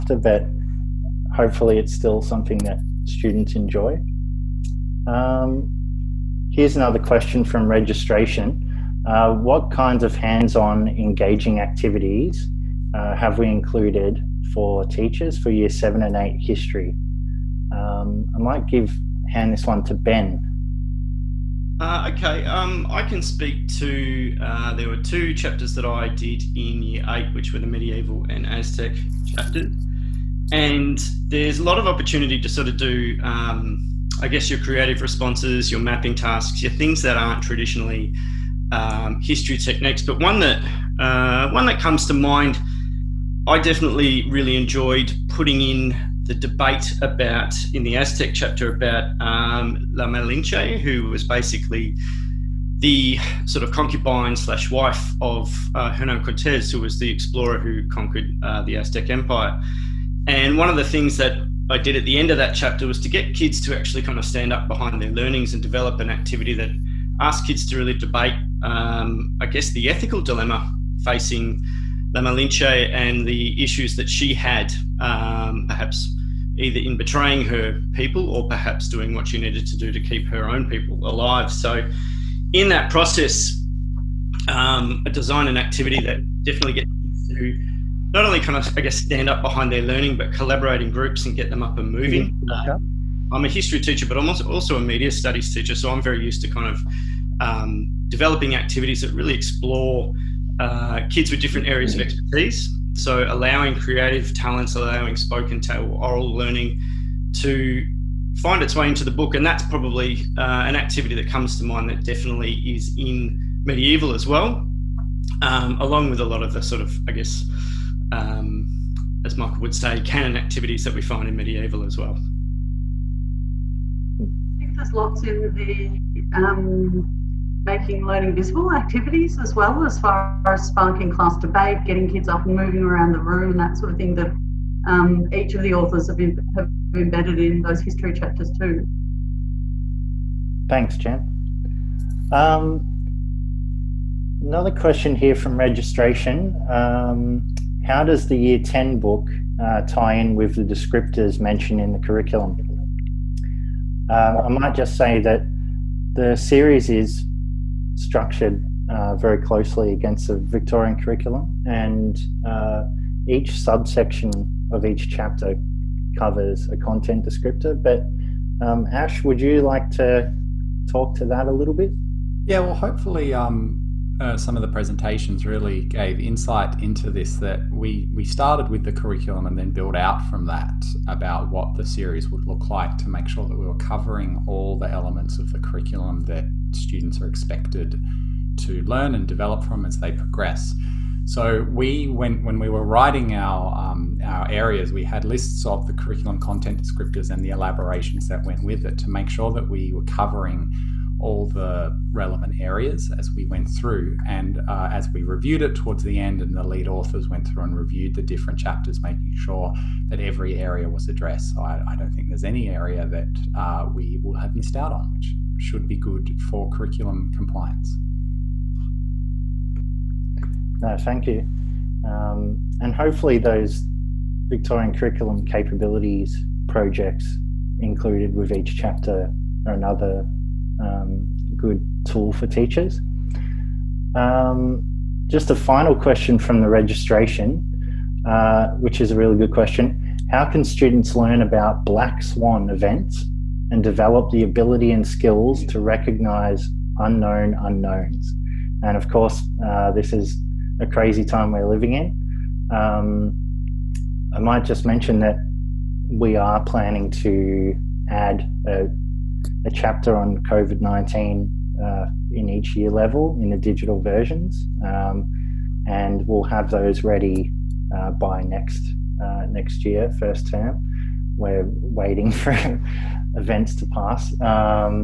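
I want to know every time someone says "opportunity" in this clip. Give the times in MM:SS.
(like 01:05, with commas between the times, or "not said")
00:31.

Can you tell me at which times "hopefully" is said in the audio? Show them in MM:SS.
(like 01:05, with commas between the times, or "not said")
00:01, 02:52, 03:42.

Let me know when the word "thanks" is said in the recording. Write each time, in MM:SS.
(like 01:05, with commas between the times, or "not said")
02:20, 03:40.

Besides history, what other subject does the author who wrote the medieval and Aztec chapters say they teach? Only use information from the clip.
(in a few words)
Media studies.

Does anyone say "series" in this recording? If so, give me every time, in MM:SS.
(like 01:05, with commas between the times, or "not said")
02:36, 03:01.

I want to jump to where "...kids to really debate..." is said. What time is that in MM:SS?
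01:07.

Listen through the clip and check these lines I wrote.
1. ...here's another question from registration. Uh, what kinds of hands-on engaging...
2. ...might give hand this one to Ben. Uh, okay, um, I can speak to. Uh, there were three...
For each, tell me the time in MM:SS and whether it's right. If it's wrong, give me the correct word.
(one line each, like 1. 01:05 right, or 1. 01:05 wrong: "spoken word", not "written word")
1. 00:06 right
2. 00:18 wrong: "two", not "three".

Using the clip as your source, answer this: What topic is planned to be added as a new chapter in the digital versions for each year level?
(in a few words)
COVID-19.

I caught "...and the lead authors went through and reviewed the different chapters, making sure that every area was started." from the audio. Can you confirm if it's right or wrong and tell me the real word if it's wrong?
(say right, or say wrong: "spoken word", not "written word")
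wrong: "addressed", not "started".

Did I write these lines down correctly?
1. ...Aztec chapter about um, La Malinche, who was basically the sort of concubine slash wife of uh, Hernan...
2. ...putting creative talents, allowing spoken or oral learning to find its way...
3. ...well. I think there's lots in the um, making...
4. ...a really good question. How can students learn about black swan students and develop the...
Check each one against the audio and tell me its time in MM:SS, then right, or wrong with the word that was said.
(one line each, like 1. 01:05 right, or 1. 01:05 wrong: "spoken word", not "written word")
1. 00:47 right
2. 01:43 wrong: "allowing", not "putting"
3. 02:01 right
4. 03:59 wrong: "events", not "students".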